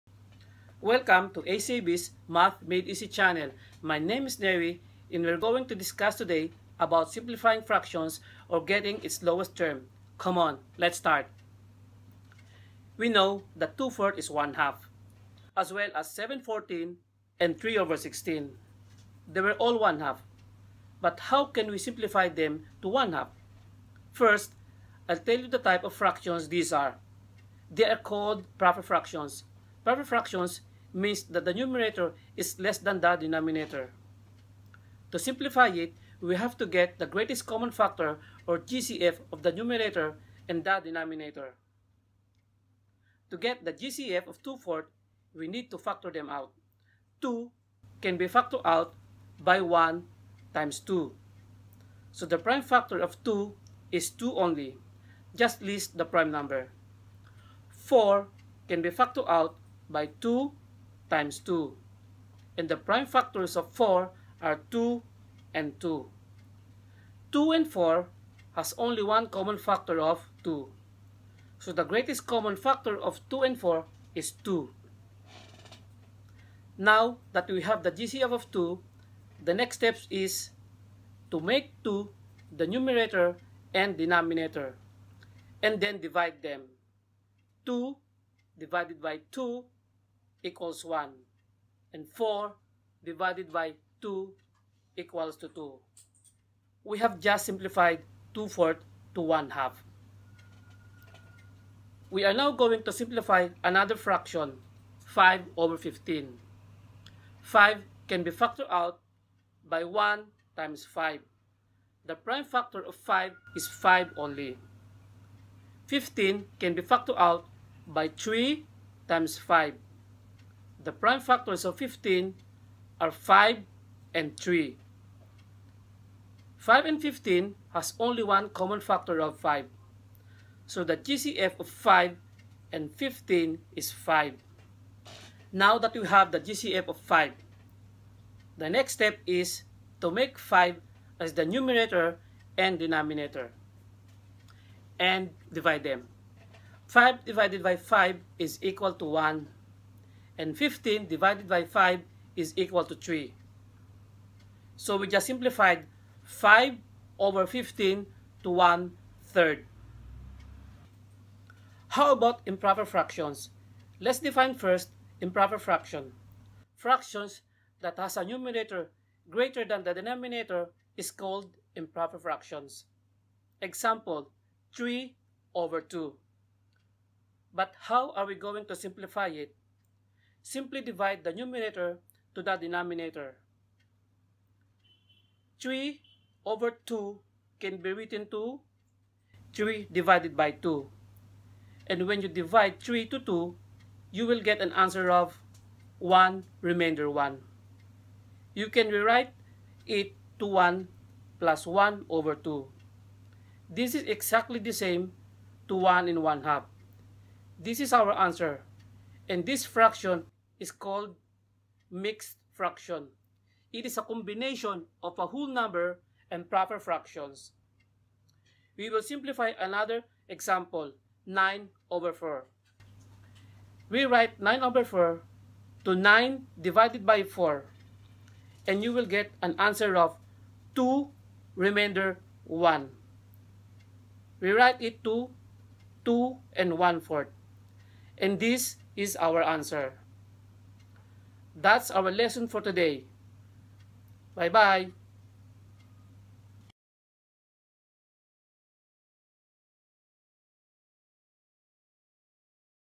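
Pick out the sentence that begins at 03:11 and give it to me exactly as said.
And when you divide 3 to 2, you will get an answer of 1 remainder 1.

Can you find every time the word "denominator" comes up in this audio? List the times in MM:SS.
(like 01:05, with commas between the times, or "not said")
00:33, 00:40, 01:23, 02:22, 02:49, 03:02.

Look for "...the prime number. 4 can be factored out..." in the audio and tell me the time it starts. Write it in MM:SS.
00:55.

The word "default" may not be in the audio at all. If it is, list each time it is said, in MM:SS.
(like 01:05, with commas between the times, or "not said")
not said.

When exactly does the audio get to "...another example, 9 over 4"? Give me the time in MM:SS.
03:39.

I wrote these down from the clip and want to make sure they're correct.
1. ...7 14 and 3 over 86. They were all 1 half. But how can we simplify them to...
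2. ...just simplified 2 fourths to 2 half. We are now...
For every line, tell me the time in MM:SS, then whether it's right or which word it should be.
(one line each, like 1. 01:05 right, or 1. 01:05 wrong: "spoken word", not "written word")
1. 00:16 wrong: "16", not "86"
2. 01:37 wrong: "1", not "2".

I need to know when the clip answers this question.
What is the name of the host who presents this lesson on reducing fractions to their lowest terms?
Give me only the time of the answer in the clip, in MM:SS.
00:04.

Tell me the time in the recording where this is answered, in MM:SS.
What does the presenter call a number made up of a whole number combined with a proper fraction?
03:31.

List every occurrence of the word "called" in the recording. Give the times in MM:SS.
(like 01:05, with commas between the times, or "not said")
00:28, 02:51, 03:30.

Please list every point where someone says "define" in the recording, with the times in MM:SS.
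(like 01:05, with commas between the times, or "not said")
02:44.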